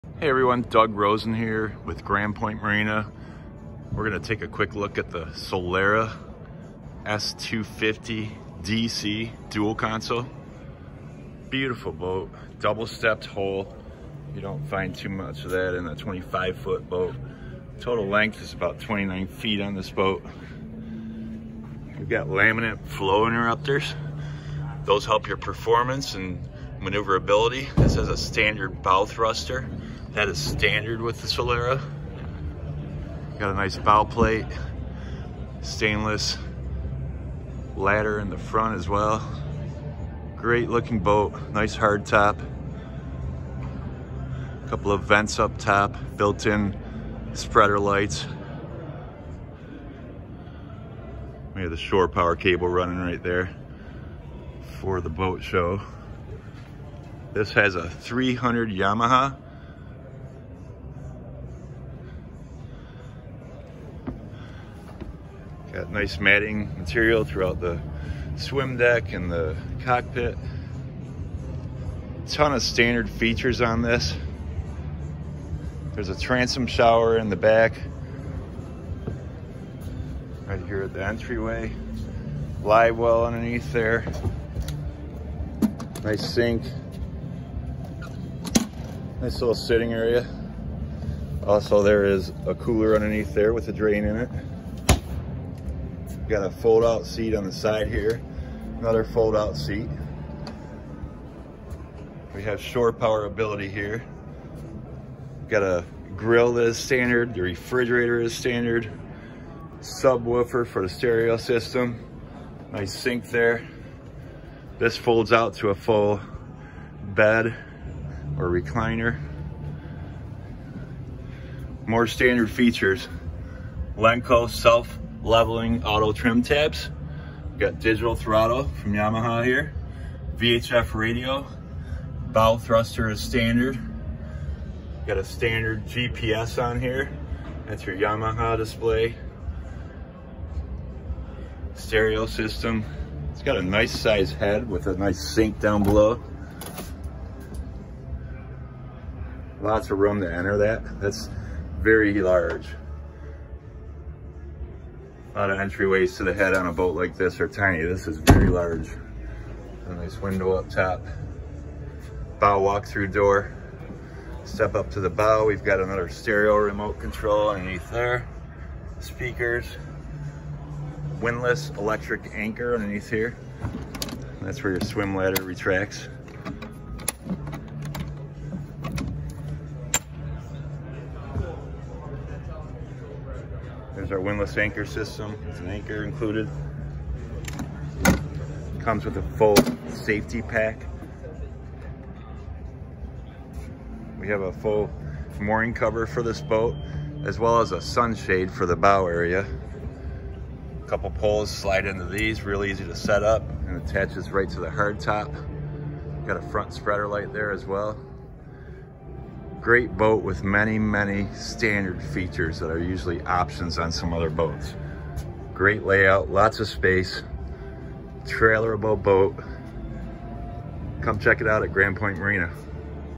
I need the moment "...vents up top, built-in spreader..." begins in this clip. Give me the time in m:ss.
0:45.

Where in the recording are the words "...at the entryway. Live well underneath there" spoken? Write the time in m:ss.
1:20.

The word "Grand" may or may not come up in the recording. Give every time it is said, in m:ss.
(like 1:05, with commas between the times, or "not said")
0:02, 3:41.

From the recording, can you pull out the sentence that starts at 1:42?
We have shore power ability here.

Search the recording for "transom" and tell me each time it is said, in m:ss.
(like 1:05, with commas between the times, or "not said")
1:16.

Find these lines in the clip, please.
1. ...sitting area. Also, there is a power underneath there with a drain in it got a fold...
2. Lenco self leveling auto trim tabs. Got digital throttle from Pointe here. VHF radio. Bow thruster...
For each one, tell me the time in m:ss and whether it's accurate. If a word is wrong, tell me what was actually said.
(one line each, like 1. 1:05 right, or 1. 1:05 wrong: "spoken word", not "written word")
1. 1:29 wrong: "cooler", not "power"
2. 2:03 wrong: "Yamaha", not "Pointe".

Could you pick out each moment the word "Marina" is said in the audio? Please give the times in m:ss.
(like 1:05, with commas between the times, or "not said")
0:02, 3:42.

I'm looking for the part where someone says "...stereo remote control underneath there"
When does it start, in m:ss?
2:46.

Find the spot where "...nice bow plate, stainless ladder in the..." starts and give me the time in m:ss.
0:33.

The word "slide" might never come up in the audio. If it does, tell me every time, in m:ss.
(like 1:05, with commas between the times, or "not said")
3:21.